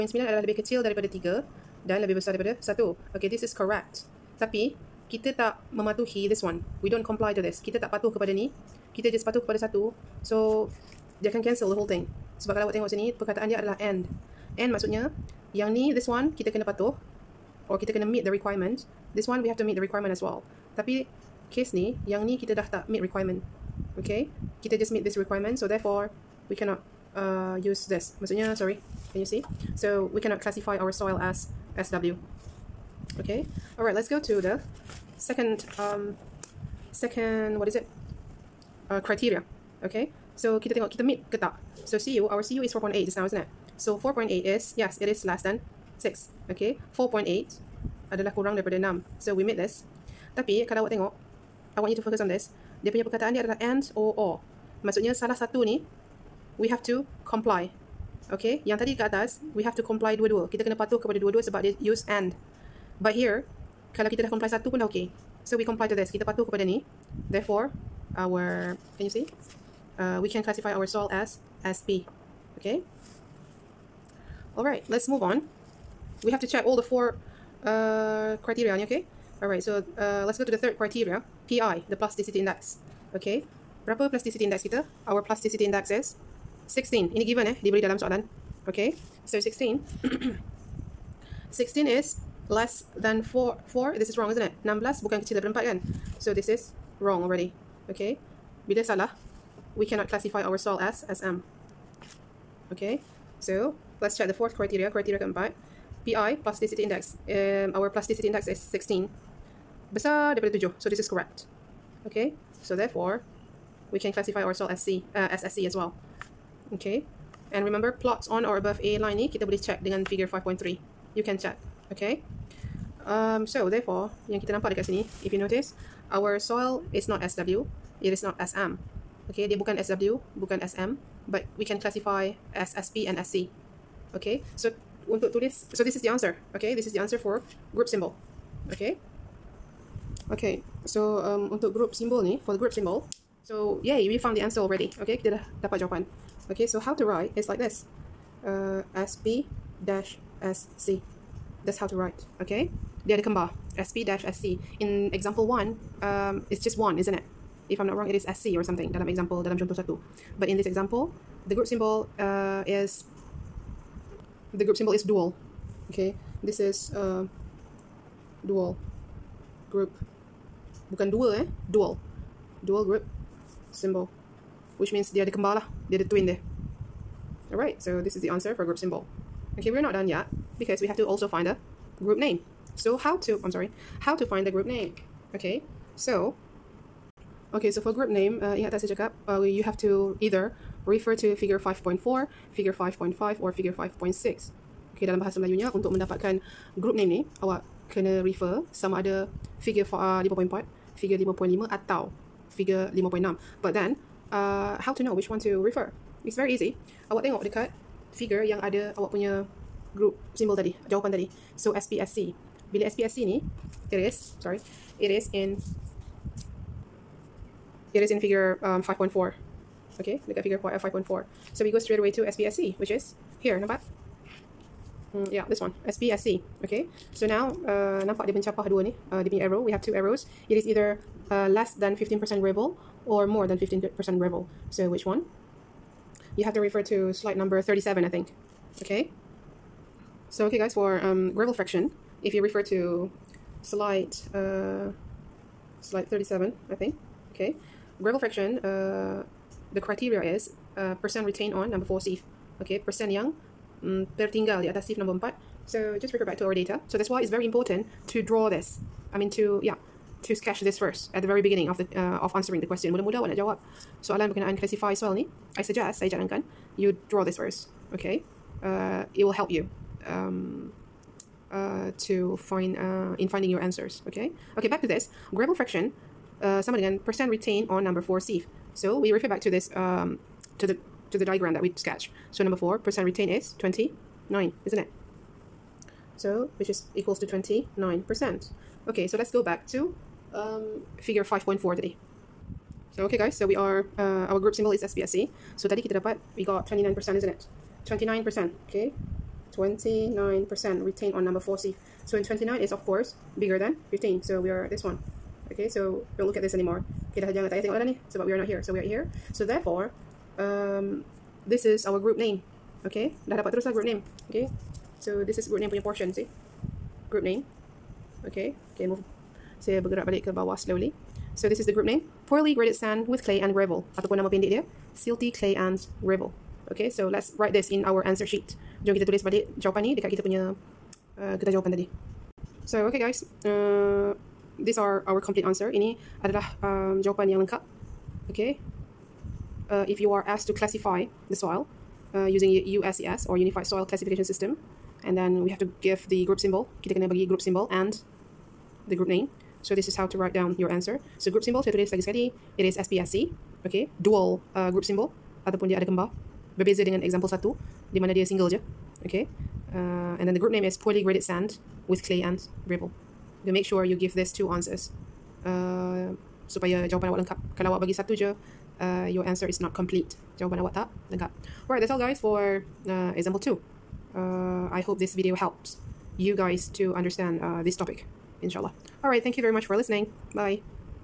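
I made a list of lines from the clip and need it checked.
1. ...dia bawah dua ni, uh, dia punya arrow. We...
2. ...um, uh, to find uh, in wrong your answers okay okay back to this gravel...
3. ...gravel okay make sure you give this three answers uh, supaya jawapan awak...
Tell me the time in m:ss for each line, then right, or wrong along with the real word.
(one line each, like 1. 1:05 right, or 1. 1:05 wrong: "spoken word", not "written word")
1. 3:48 wrong: "mencapah", not "bawah"
2. 4:30 wrong: "finding", not "wrong"
3. 6:02 wrong: "two", not "three".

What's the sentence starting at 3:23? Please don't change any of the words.
But then uh, how to know which one to refer?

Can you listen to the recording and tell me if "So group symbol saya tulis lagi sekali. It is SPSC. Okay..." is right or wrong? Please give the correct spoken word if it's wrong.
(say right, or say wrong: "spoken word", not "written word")
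right.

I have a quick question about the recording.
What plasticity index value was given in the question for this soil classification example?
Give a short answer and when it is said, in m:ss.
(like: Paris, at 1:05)
16, at 1:25.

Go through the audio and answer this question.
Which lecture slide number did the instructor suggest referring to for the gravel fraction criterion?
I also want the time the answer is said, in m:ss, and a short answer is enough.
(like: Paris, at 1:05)
37, at 3:57.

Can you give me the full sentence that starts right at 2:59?
Okay, we're not done yet because we have to also find the group name.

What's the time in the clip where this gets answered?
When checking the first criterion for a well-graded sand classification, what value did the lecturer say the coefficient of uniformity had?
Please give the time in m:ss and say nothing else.
0:42.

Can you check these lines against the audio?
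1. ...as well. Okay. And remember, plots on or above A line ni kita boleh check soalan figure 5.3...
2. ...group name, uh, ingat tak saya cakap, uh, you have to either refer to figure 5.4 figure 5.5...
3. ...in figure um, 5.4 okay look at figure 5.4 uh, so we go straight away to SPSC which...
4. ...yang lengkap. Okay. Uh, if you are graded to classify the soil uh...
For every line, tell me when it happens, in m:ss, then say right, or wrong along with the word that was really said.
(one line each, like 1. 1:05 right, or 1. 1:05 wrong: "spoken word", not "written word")
1. 1:55 wrong: "dengan", not "soalan"
2. 3:07 right
3. 3:38 right
4. 5:37 wrong: "asked", not "graded".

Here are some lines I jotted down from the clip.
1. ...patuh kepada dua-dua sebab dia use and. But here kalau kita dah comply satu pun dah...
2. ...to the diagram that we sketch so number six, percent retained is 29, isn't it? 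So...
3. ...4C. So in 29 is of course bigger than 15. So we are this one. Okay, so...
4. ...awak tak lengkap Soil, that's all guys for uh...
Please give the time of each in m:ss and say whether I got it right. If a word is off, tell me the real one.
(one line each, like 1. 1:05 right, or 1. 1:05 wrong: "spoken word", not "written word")
1. 1:00 right
2. 4:41 wrong: "four", not "six"
3. 5:01 right
4. 6:10 wrong: "Alright", not "Soil".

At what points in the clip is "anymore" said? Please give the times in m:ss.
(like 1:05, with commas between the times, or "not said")
5:06.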